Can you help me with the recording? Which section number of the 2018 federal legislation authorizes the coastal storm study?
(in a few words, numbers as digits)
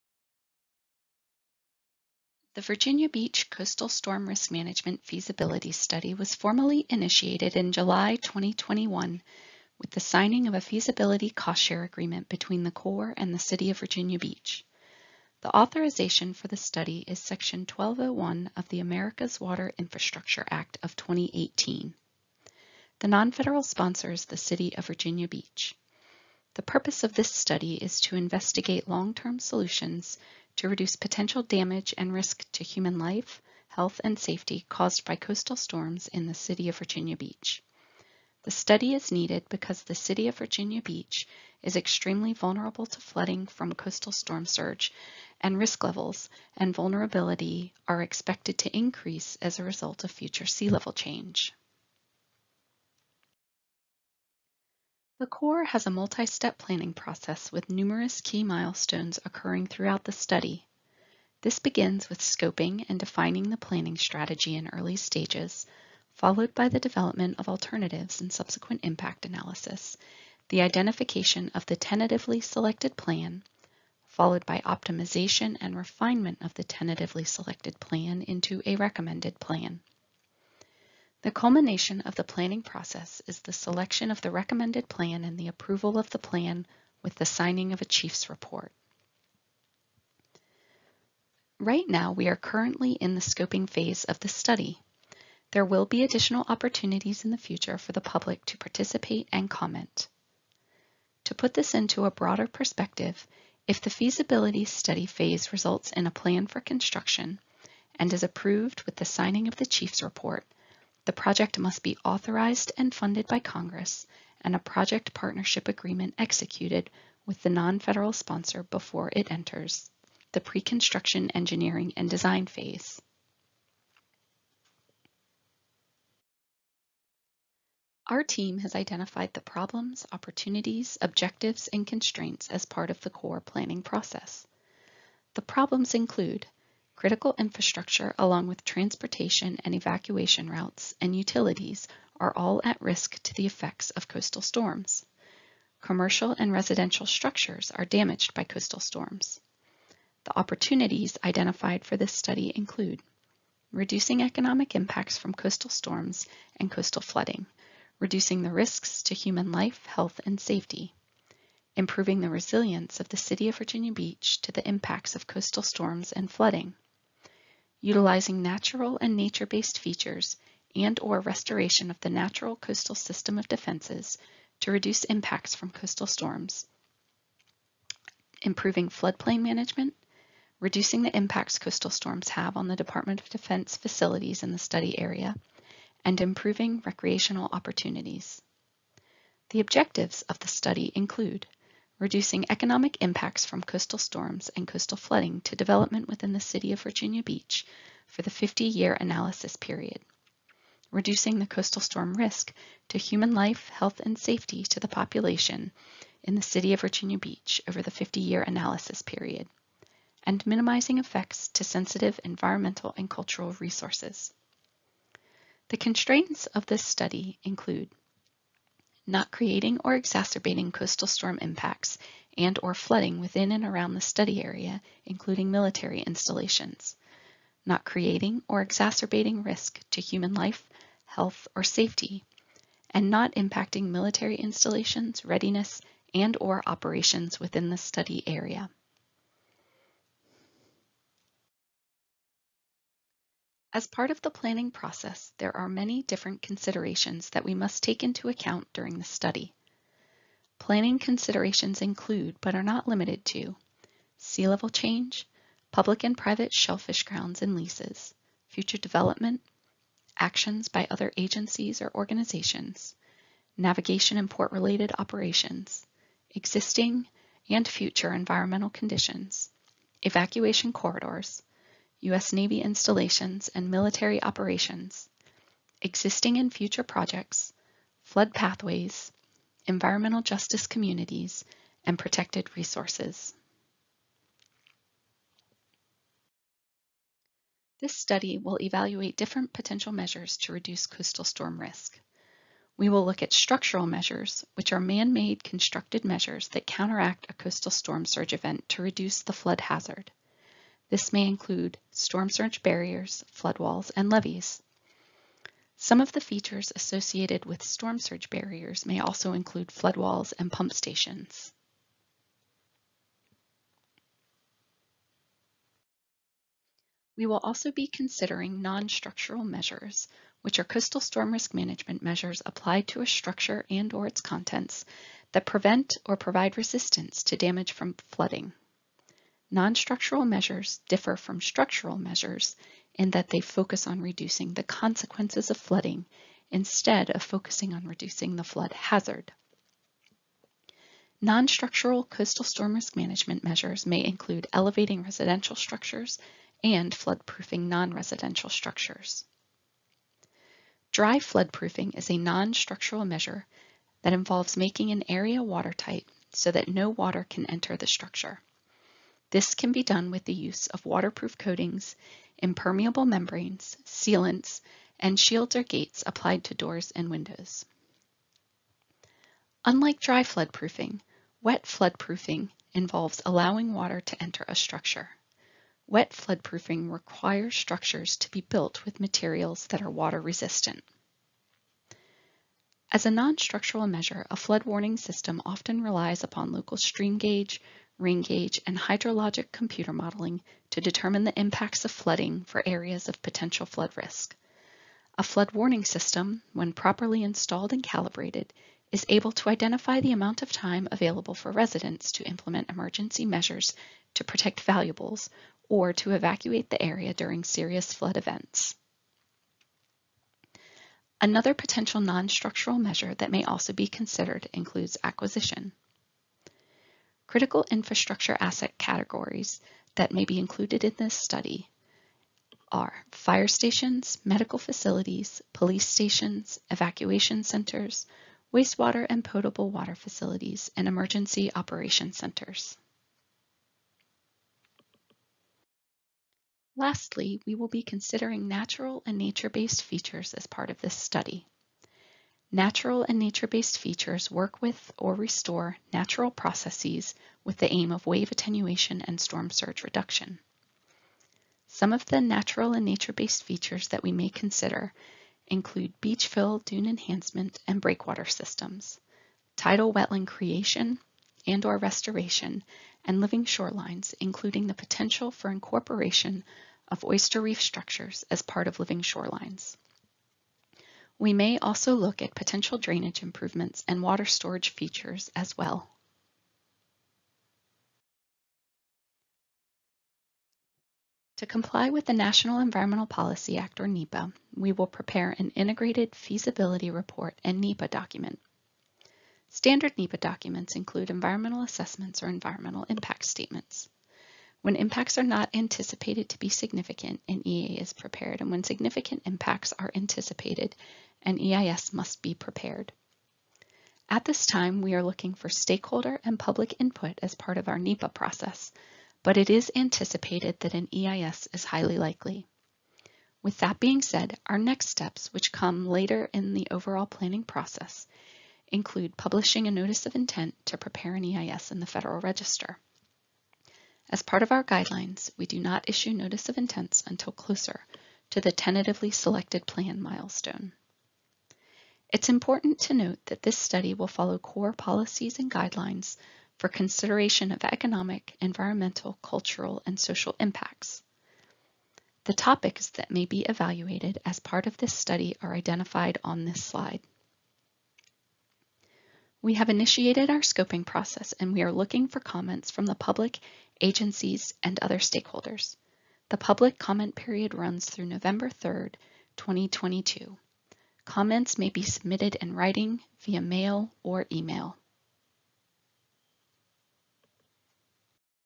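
Section 1201.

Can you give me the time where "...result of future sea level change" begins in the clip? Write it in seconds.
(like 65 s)
49 s.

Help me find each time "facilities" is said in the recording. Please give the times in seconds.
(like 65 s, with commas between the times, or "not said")
183 s, 424 s, 429 s.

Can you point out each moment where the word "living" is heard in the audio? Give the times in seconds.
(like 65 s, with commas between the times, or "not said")
463 s, 468 s.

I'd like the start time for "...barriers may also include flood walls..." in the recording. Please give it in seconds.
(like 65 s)
308 s.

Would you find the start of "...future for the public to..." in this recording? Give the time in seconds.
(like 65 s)
97 s.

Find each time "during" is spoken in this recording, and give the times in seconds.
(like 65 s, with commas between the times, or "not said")
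248 s, 407 s.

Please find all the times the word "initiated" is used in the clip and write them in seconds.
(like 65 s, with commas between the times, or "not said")
6 s, 549 s.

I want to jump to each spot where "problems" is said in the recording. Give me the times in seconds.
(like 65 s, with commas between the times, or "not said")
129 s, 135 s.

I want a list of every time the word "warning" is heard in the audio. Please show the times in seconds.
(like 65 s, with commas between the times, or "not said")
384 s, 395 s.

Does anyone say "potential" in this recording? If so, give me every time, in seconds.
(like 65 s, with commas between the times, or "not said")
30 s, 289 s, 393 s, 411 s, 464 s, 472 s.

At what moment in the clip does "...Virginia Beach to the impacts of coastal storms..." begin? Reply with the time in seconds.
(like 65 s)
163 s.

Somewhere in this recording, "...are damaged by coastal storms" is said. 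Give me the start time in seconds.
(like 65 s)
147 s.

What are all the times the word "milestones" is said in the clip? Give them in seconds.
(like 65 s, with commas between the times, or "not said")
58 s, 530 s.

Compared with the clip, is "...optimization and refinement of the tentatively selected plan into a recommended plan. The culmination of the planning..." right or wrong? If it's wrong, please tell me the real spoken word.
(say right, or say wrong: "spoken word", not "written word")
right.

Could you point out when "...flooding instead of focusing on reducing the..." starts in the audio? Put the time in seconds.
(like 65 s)
335 s.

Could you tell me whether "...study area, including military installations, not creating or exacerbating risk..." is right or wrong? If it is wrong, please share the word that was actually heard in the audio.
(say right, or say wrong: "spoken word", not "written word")
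right.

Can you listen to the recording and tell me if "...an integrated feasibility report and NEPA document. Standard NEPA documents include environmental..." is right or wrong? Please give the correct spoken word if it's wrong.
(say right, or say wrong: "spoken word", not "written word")
right.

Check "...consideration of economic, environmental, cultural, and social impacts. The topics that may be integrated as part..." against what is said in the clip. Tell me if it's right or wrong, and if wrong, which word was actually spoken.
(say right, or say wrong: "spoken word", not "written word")
wrong: "evaluated", not "integrated".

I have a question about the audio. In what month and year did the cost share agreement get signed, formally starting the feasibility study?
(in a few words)
July 2021.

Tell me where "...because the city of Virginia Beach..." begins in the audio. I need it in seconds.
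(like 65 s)
39 s.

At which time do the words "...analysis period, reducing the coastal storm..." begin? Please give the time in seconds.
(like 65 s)
198 s.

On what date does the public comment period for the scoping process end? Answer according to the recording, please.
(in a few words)
November 3, 2022.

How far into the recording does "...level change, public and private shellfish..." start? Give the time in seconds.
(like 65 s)
254 s.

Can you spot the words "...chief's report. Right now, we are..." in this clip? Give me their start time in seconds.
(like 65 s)
87 s.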